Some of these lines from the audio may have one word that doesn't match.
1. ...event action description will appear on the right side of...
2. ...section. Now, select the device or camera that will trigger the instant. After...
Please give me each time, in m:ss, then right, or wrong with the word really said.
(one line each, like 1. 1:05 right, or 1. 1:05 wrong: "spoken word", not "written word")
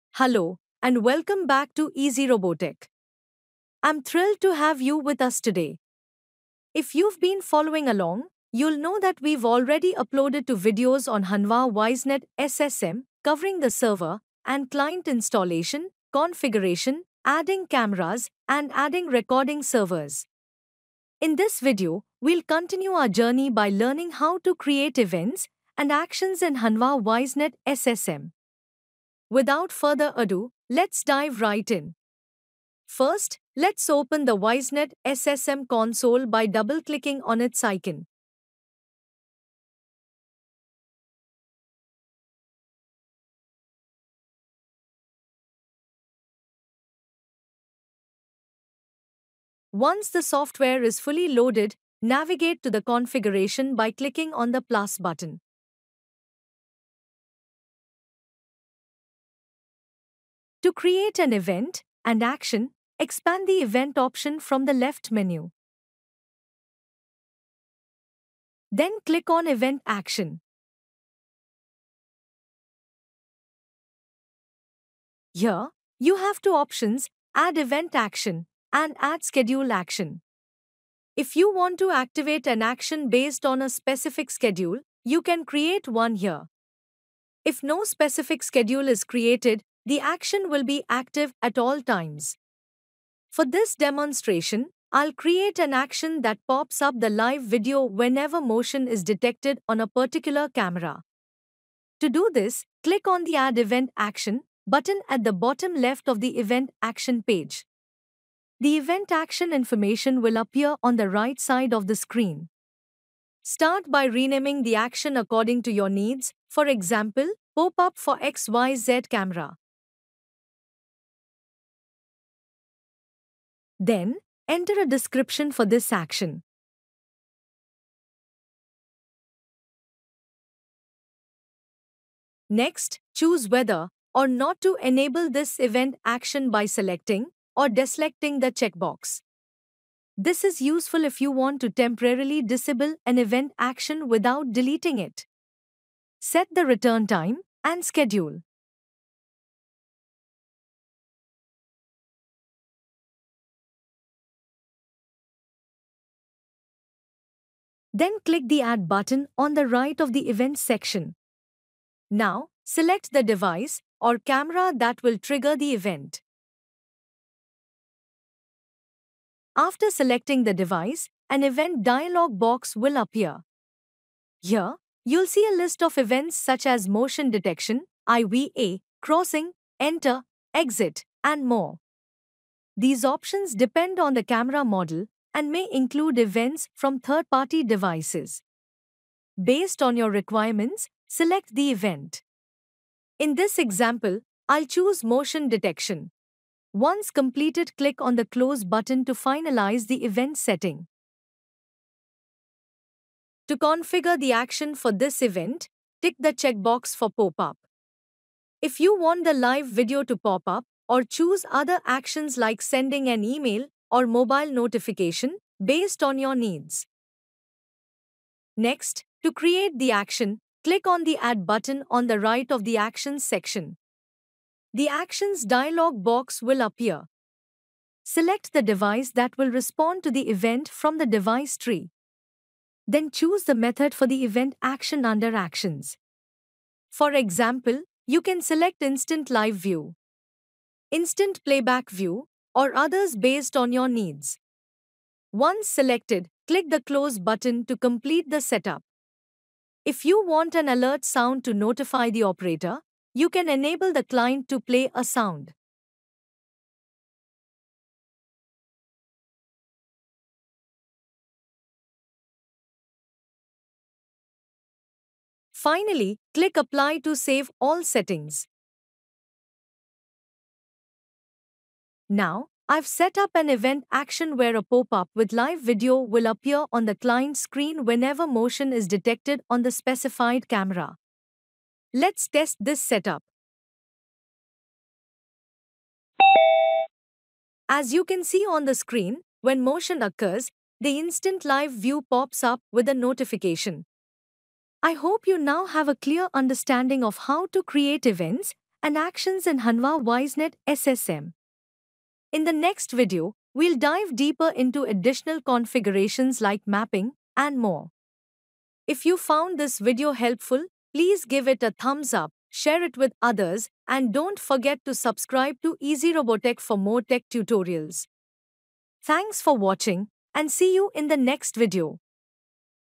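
1. 1:48 wrong: "information", not "description"
2. 2:40 wrong: "event", not "instant".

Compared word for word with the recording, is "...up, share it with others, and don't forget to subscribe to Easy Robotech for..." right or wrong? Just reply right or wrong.
right.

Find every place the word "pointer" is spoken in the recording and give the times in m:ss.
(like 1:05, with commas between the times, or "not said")
not said.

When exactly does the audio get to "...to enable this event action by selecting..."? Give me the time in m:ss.
2:14.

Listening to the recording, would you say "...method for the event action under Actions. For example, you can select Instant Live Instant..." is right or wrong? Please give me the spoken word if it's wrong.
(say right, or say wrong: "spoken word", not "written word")
wrong: "View", not "Instant".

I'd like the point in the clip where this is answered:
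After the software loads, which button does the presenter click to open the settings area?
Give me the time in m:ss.
0:54.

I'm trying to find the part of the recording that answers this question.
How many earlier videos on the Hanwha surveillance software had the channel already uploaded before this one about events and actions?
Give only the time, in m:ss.
0:10.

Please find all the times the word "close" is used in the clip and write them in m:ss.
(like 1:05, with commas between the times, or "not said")
3:18, 4:06.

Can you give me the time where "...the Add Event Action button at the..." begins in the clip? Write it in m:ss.
1:43.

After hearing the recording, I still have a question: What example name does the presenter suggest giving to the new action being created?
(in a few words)
pop up for XYZ camera.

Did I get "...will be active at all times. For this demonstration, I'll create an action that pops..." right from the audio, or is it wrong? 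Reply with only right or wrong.
right.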